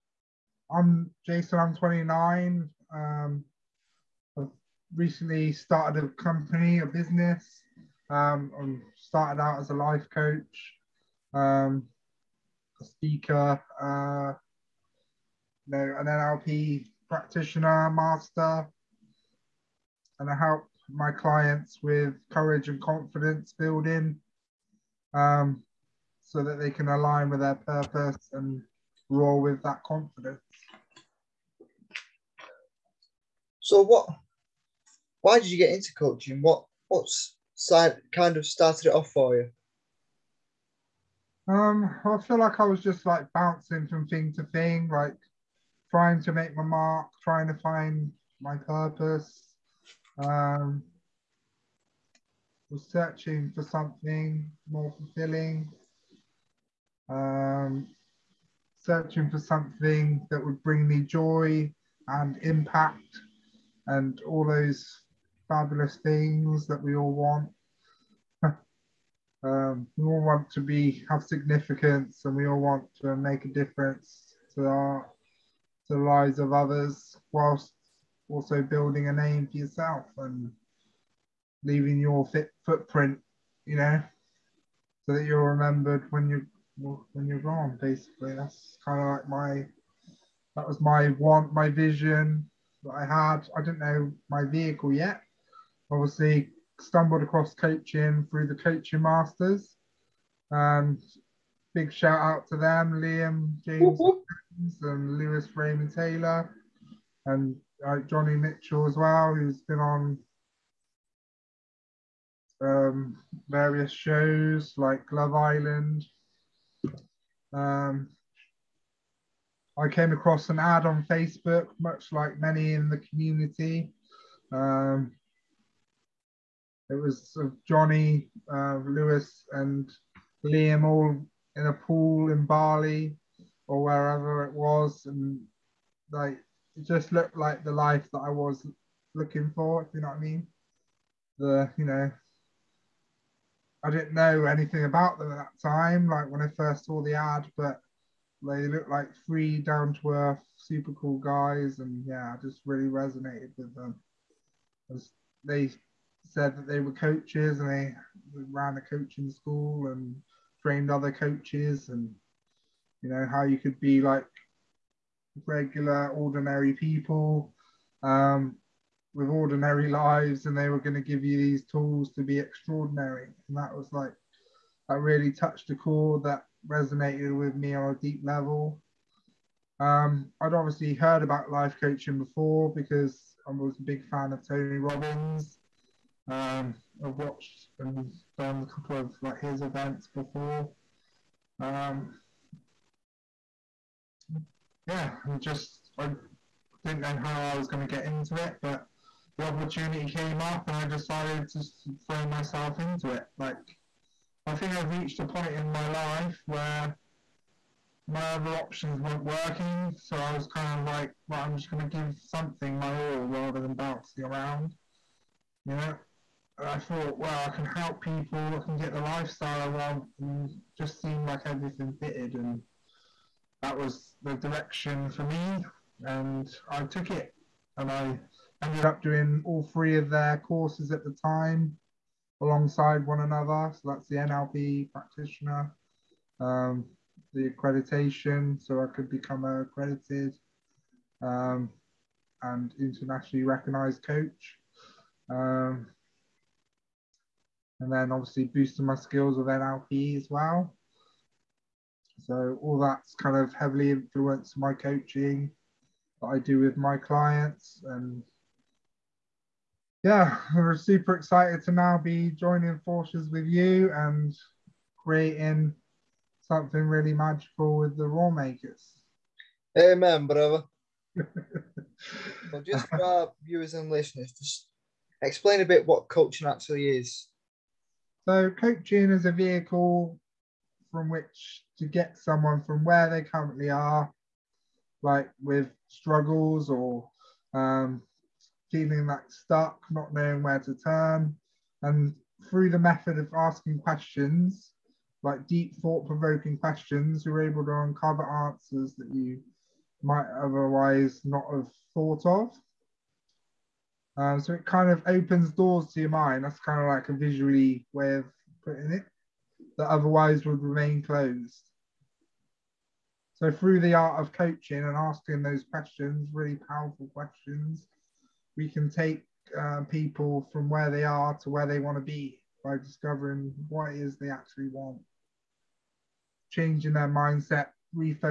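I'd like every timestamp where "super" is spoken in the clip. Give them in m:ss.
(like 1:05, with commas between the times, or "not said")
2:30, 4:20.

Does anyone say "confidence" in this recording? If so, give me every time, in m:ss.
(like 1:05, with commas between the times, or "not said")
0:22, 0:29.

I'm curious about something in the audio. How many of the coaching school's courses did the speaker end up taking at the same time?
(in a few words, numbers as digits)
3.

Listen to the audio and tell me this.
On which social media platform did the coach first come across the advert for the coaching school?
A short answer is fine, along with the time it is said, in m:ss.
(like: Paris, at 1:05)
Facebook, at 2:01.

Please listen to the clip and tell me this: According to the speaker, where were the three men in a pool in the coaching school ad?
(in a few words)
Bali.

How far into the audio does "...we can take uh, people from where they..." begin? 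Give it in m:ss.
5:18.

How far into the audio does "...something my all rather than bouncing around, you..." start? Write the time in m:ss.
3:32.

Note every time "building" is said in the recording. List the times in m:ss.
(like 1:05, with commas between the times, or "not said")
0:23, 1:18.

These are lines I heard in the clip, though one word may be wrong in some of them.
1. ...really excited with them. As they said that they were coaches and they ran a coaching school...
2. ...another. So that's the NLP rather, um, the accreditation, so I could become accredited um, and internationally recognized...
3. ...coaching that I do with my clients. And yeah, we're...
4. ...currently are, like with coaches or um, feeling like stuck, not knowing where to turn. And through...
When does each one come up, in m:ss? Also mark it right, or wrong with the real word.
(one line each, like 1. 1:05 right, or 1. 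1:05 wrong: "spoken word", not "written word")
1. 2:32 wrong: "resonated", not "excited"
2. 3:53 wrong: "practitioner", not "rather"
3. 4:14 right
4. 4:43 wrong: "struggles", not "coaches".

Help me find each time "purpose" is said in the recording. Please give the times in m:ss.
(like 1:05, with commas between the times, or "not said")
0:27, 0:48.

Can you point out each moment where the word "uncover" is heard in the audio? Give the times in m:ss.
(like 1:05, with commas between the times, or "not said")
4:57.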